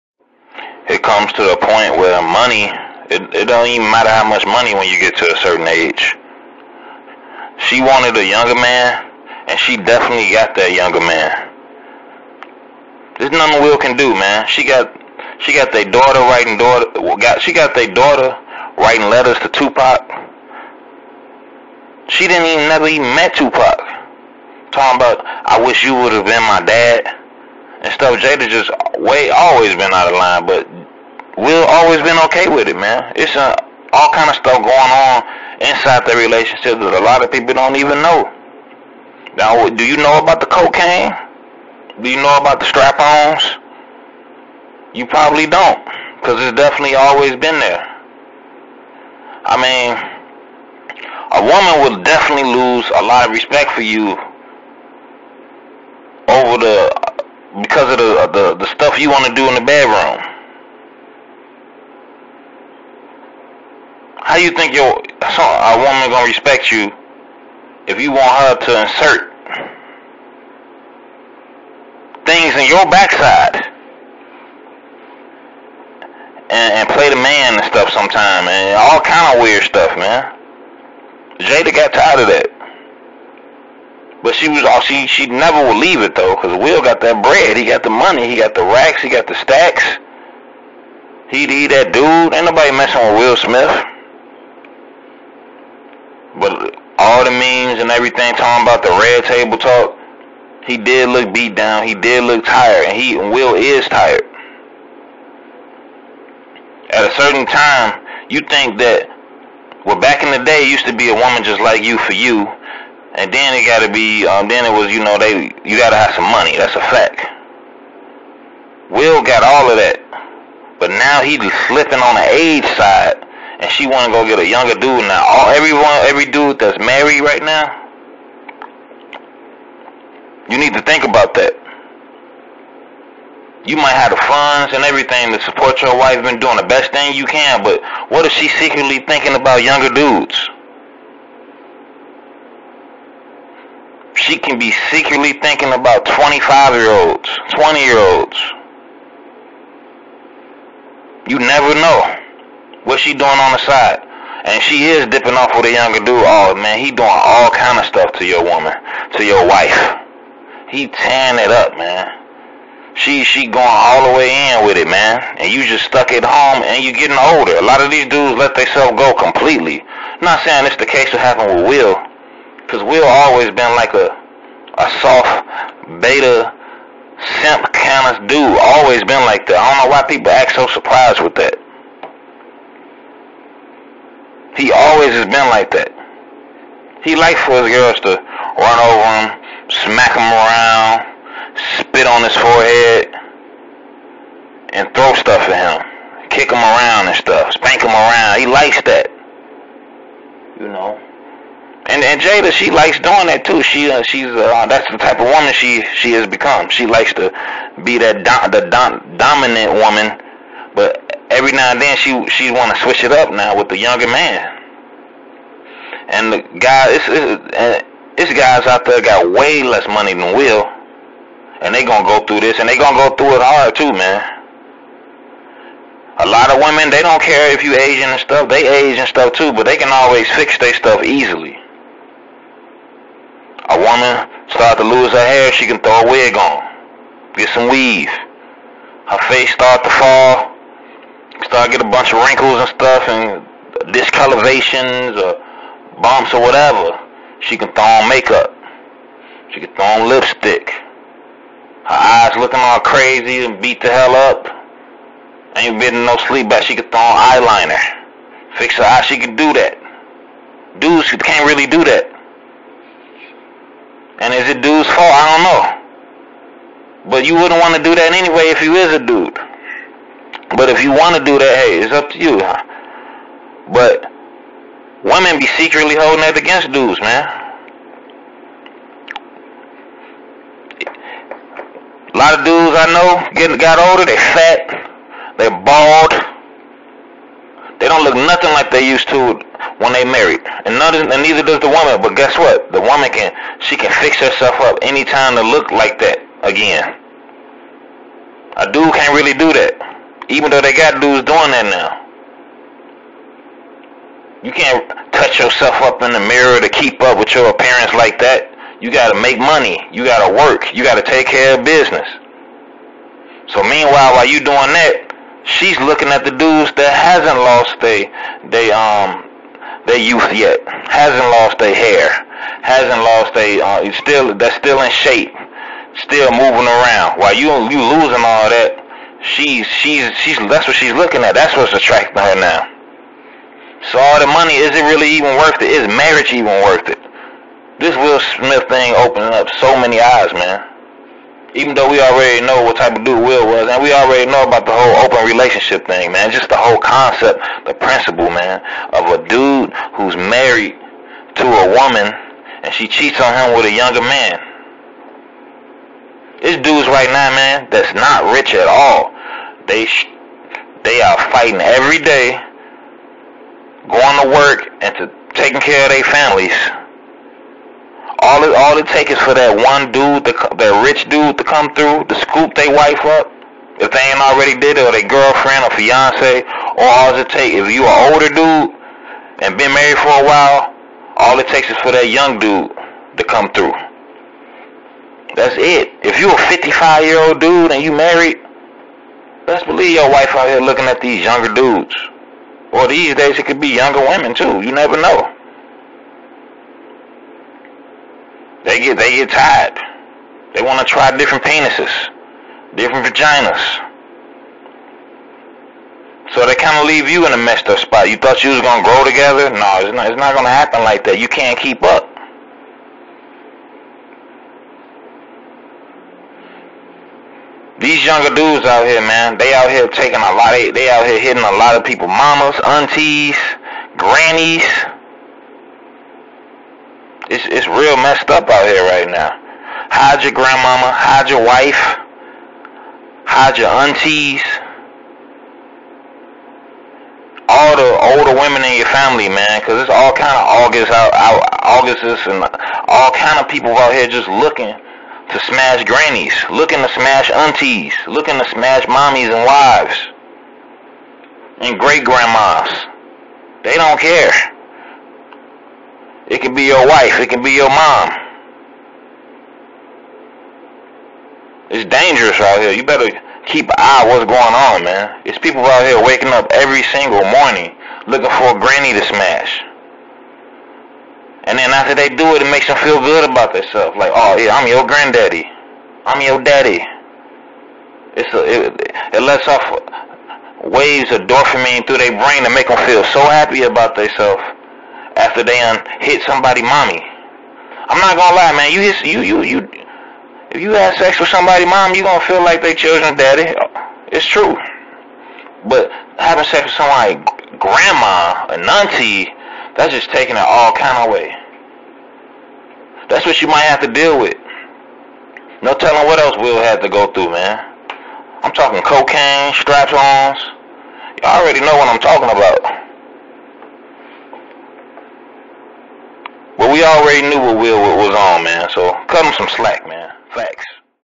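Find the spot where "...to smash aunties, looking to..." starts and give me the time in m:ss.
7:26.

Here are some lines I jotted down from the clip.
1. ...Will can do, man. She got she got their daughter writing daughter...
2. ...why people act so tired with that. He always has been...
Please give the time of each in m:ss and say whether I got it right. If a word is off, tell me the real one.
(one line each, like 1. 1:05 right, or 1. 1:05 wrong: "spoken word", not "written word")
1. 0:13 right
2. 2:59 wrong: "surprised", not "tired".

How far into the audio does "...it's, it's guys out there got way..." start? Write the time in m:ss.
3:37.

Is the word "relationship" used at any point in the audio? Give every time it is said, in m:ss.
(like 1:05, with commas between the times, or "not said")
0:36, 5:45.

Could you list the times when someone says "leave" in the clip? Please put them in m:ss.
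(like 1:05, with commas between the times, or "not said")
1:25, 6:46.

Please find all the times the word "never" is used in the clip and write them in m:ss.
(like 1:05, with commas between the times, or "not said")
0:22, 1:25, 2:31, 6:34.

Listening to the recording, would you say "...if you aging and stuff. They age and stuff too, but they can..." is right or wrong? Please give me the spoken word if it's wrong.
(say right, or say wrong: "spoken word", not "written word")
right.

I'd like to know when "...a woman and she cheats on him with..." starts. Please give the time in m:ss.
5:51.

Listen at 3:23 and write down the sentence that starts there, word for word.
She uh, she's uh, that's the type of woman she she has become.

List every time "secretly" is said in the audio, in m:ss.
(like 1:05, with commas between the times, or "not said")
2:18, 2:24, 4:35.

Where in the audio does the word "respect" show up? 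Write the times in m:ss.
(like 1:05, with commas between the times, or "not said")
0:53, 1:06.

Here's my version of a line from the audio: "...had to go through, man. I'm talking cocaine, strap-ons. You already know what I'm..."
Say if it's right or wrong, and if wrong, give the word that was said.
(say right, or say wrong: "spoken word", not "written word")
right.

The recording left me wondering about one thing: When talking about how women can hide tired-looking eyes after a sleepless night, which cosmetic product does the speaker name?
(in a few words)
eyeliner.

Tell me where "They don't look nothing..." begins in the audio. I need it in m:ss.
4:47.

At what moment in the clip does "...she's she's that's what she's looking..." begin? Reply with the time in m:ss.
5:29.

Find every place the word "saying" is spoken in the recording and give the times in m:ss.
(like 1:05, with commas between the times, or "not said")
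2:50.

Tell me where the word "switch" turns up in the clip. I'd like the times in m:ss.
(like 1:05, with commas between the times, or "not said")
3:32.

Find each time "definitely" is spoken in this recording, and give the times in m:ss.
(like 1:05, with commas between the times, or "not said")
0:09, 0:46, 0:52.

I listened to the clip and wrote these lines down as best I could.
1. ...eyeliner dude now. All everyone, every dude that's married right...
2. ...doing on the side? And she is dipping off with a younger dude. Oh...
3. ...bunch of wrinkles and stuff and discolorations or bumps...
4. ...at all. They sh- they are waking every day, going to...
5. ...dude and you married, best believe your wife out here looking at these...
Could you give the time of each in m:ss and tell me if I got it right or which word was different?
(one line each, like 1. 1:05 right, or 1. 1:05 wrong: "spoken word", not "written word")
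1. 2:04 wrong: "younger", not "eyeliner"
2. 2:33 right
3. 4:01 right
4. 5:58 wrong: "fighting", not "waking"
5. 6:27 right.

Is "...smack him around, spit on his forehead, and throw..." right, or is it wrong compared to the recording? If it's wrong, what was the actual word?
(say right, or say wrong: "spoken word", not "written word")
right.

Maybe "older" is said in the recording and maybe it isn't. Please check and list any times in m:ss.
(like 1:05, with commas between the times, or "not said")
2:47, 4:43, 6:18, 7:18.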